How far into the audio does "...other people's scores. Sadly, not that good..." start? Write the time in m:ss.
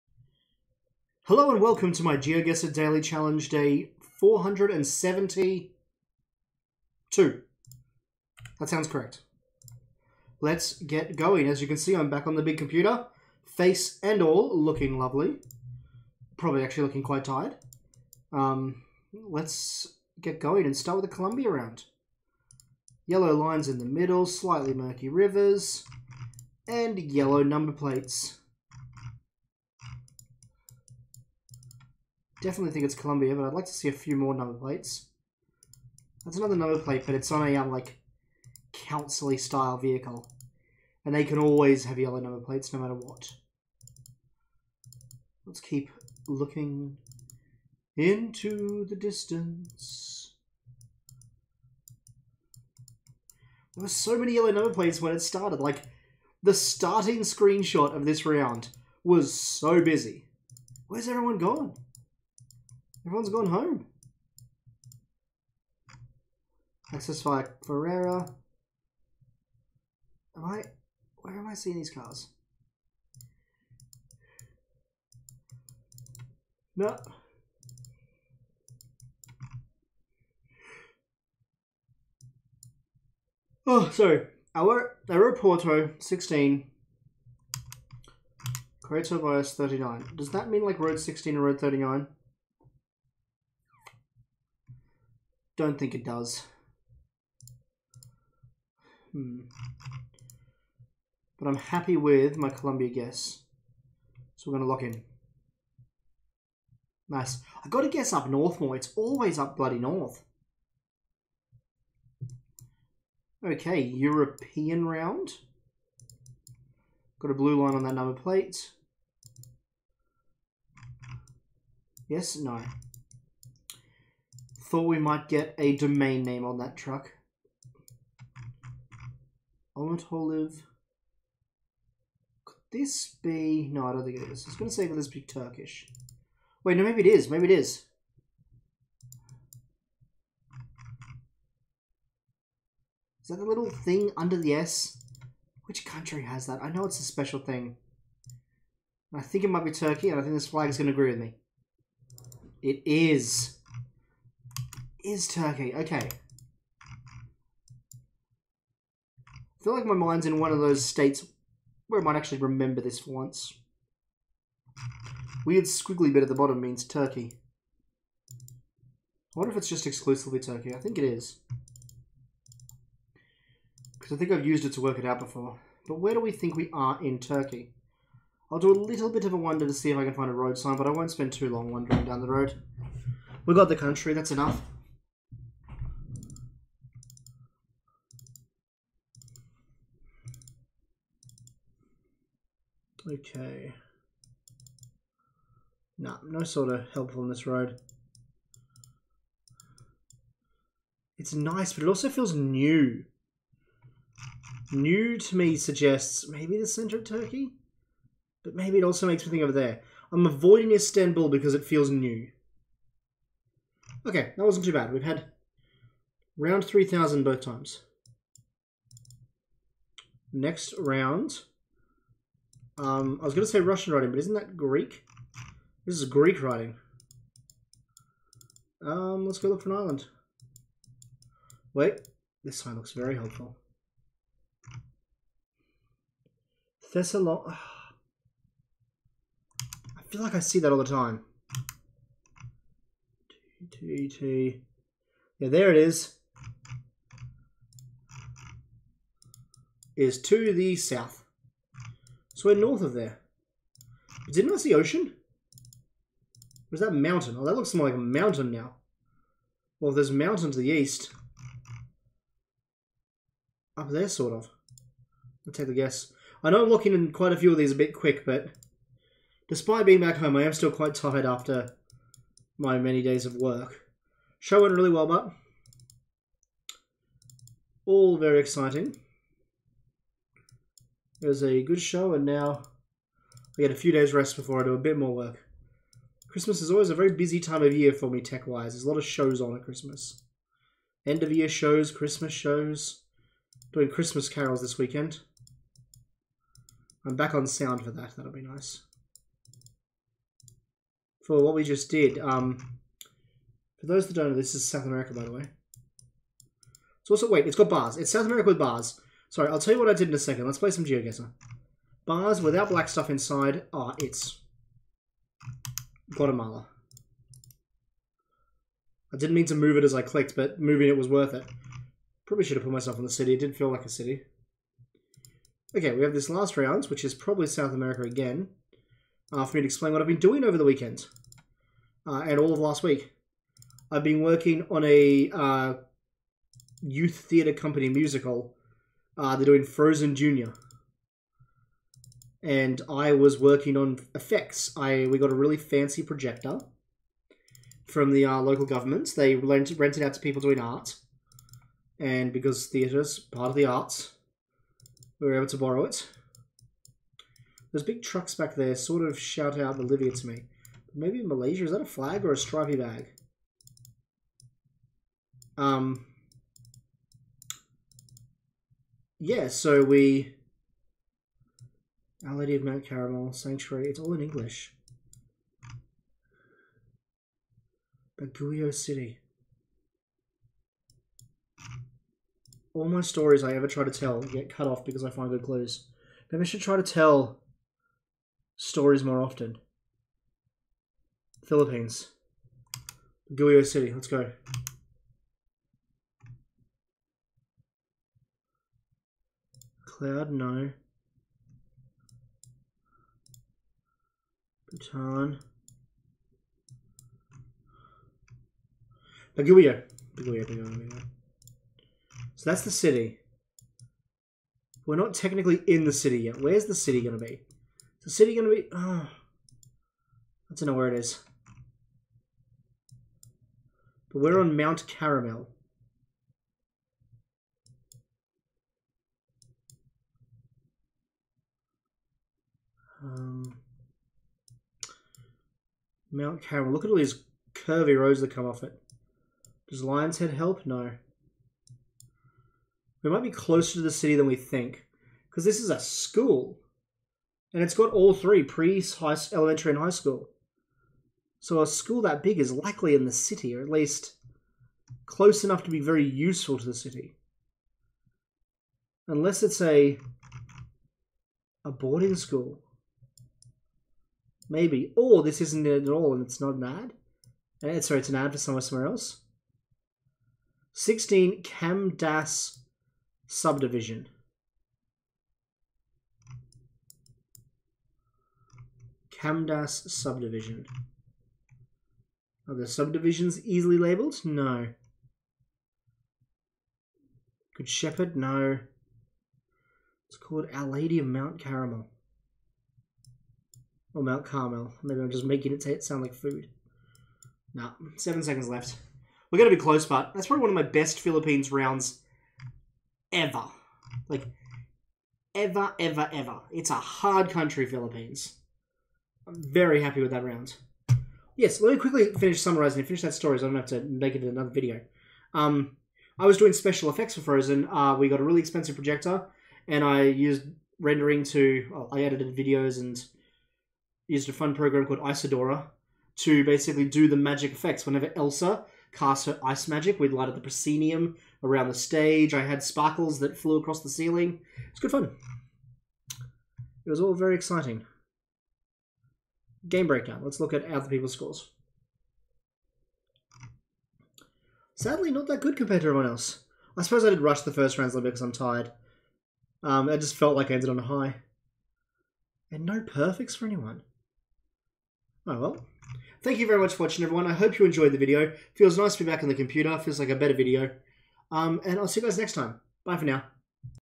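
9:00.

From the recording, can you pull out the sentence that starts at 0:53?
There were so many yellow number plates when it started.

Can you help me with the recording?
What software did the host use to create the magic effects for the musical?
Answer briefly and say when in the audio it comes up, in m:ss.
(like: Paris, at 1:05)
Isadora, at 8:45.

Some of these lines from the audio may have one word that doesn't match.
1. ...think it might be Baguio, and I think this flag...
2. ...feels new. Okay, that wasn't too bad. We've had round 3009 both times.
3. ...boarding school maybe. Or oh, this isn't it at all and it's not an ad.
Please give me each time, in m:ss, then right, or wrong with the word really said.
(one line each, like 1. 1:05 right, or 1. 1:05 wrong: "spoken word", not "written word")
1. 2:29 wrong: "Turkey", not "Baguio"
2. 3:31 wrong: "3000", not "3009"
3. 7:41 right.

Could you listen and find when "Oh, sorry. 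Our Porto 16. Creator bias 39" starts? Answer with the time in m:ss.
1:23.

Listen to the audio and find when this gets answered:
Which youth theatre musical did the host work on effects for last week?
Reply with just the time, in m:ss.
5:39.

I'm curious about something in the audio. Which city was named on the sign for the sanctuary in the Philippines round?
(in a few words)
Baguio City.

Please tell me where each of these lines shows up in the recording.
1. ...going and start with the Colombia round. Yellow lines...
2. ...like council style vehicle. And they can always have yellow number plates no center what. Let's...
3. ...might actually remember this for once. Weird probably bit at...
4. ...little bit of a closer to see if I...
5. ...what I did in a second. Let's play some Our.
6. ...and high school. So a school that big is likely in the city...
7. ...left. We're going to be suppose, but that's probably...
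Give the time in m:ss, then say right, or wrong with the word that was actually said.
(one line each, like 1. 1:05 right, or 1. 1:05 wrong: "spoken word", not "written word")
1. 0:20 right
2. 0:37 wrong: "matter", not "center"
3. 2:42 wrong: "squiggly", not "probably"
4. 2:58 wrong: "wonder", not "closer"
5. 5:09 wrong: "GeoGuessr", not "Our"
6. 7:29 right
7. 8:18 wrong: "close", not "suppose".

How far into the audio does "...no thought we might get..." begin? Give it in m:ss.
2:02.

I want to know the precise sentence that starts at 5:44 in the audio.
I we got a really fancy projector from the uh, local government.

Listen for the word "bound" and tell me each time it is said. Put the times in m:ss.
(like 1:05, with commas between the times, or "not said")
not said.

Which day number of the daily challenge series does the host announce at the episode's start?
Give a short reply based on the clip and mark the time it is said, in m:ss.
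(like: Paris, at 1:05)
472, at 0:03.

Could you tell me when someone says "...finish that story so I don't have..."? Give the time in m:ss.
8:32.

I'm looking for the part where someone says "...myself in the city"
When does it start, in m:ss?
5:22.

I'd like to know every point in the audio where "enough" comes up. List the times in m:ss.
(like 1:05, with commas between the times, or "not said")
3:04, 7:35.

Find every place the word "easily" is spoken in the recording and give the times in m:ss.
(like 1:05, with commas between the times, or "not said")
8:03.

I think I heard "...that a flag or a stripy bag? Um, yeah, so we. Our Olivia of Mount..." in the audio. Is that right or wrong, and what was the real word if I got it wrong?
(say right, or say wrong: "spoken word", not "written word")
wrong: "Lady", not "Olivia".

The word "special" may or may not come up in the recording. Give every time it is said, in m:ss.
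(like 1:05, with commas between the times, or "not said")
2:27, 8:36.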